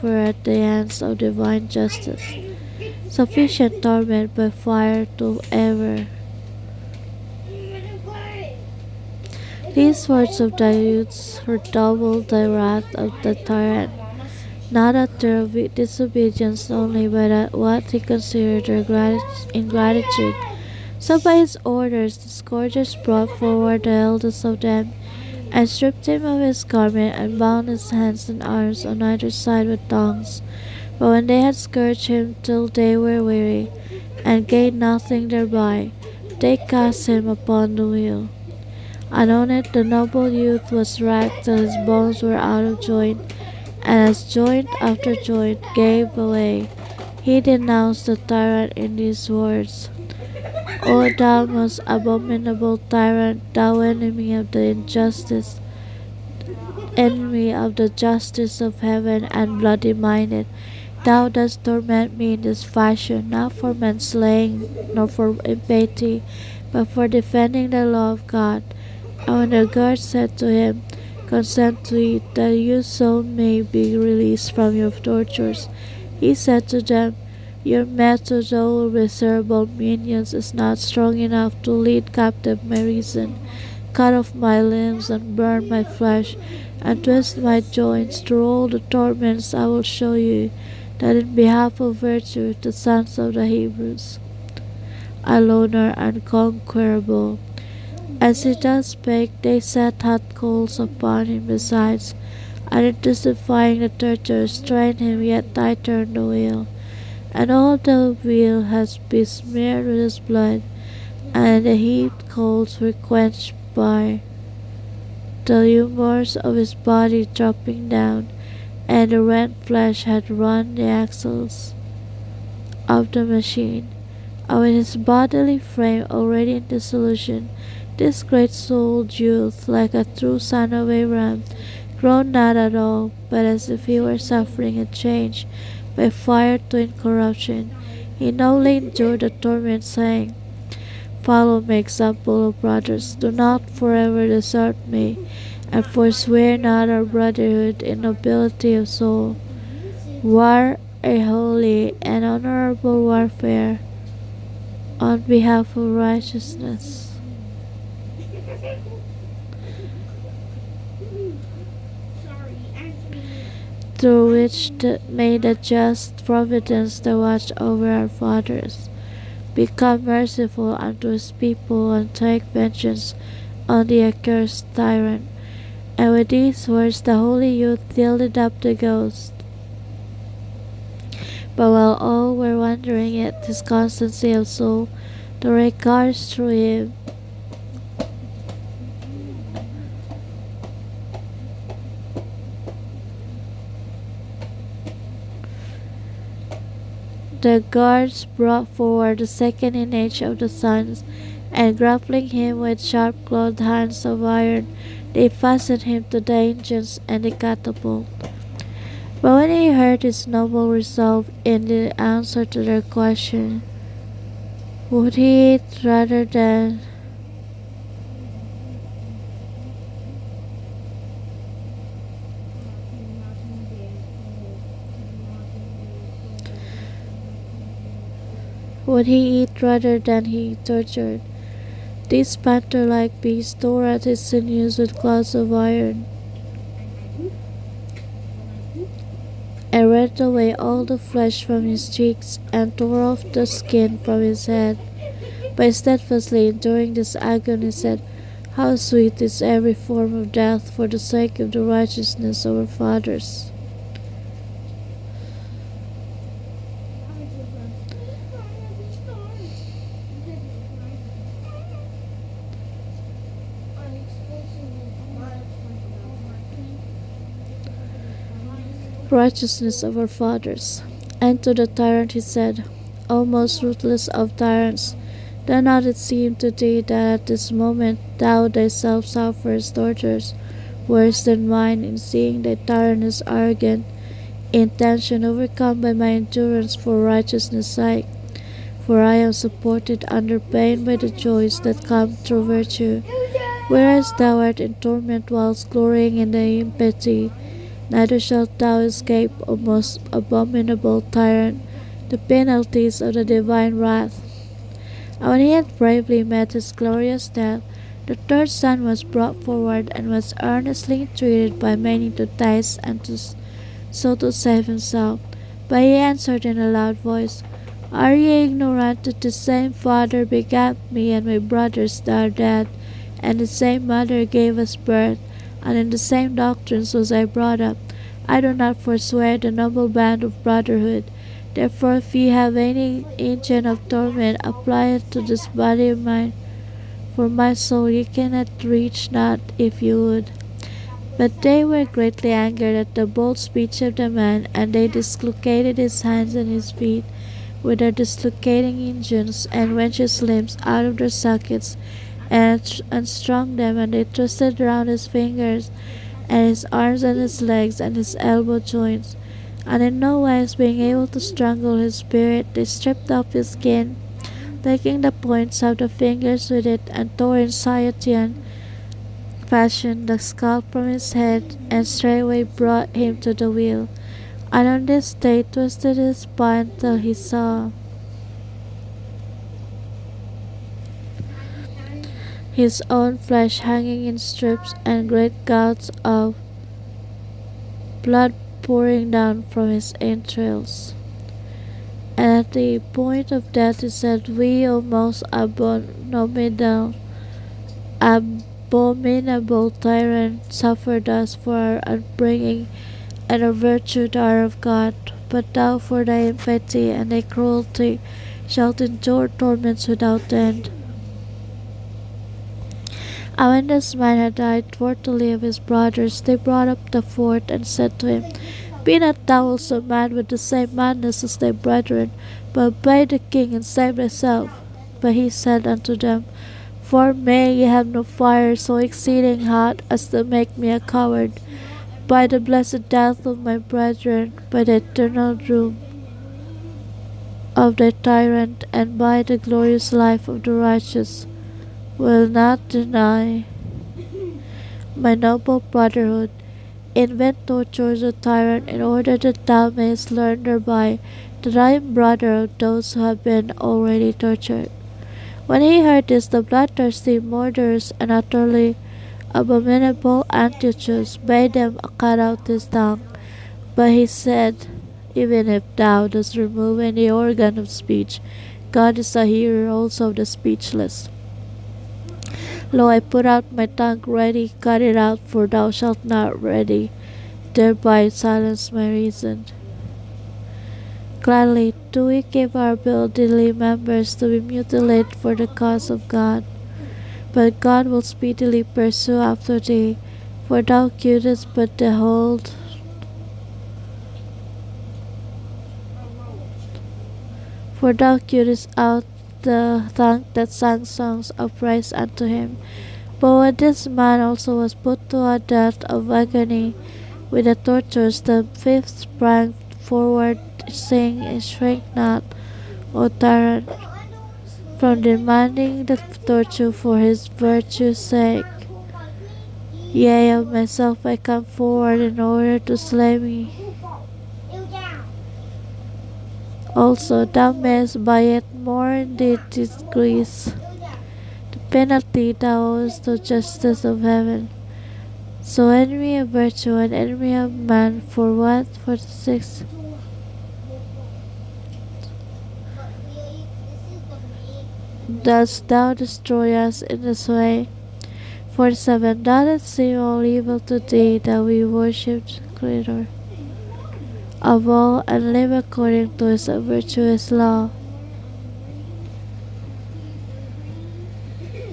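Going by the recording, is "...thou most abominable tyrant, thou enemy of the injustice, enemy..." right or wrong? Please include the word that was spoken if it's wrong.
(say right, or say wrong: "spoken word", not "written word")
right.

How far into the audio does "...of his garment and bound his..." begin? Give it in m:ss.
0:26.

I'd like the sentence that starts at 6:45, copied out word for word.
But thou for thy infamy and thy cruelty shalt endure torments without end.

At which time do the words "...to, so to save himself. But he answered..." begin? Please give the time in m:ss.
5:13.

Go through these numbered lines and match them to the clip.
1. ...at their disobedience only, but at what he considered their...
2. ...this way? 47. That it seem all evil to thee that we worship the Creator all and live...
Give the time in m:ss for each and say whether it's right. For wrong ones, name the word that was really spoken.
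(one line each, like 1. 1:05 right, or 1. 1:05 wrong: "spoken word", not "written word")
1. 0:14 right
2. 9:07 right.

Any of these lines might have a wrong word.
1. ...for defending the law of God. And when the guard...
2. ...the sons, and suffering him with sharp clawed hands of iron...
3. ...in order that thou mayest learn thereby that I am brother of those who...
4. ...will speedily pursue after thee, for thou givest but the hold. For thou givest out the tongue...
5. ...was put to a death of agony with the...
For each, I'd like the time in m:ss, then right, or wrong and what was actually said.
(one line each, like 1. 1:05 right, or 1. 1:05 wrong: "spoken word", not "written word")
1. 1:06 right
2. 3:20 wrong: "grappling", not "suffering"
3. 7:28 right
4. 8:07 right
5. 8:24 right.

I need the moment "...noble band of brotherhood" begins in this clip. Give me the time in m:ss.
5:29.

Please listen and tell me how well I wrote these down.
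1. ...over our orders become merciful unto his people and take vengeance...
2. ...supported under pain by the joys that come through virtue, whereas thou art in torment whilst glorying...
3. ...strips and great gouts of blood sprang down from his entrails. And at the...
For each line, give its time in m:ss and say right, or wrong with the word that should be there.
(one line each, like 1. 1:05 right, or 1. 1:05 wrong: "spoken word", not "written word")
1. 2:47 wrong: "fathers", not "orders"
2. 4:49 right
3. 6:24 wrong: "pouring", not "sprang".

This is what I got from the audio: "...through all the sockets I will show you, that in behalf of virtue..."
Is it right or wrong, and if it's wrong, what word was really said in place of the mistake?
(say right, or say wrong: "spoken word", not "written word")
wrong: "torments", not "sockets".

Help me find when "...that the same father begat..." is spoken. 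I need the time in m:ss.
5:19.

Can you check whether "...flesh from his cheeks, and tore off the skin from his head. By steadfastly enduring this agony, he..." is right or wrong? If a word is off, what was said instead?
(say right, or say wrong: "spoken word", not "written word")
right.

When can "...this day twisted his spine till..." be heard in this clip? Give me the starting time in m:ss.
6:14.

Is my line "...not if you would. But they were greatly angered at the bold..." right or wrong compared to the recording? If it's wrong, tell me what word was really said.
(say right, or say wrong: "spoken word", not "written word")
right.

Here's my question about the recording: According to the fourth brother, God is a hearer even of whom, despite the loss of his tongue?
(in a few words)
The speechless.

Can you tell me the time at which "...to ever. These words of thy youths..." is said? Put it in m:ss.
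0:05.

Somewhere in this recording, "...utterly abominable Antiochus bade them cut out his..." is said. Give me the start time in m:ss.
7:38.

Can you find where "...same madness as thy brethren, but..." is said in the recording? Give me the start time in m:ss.
7:00.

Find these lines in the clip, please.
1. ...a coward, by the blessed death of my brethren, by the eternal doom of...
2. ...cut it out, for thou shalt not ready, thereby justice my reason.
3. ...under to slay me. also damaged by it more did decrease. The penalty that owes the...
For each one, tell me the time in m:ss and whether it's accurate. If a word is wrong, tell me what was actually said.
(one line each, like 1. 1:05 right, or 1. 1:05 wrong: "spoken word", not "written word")
1. 7:10 right
2. 7:54 wrong: "silence", not "justice"
3. 8:42 wrong: "order", not "under".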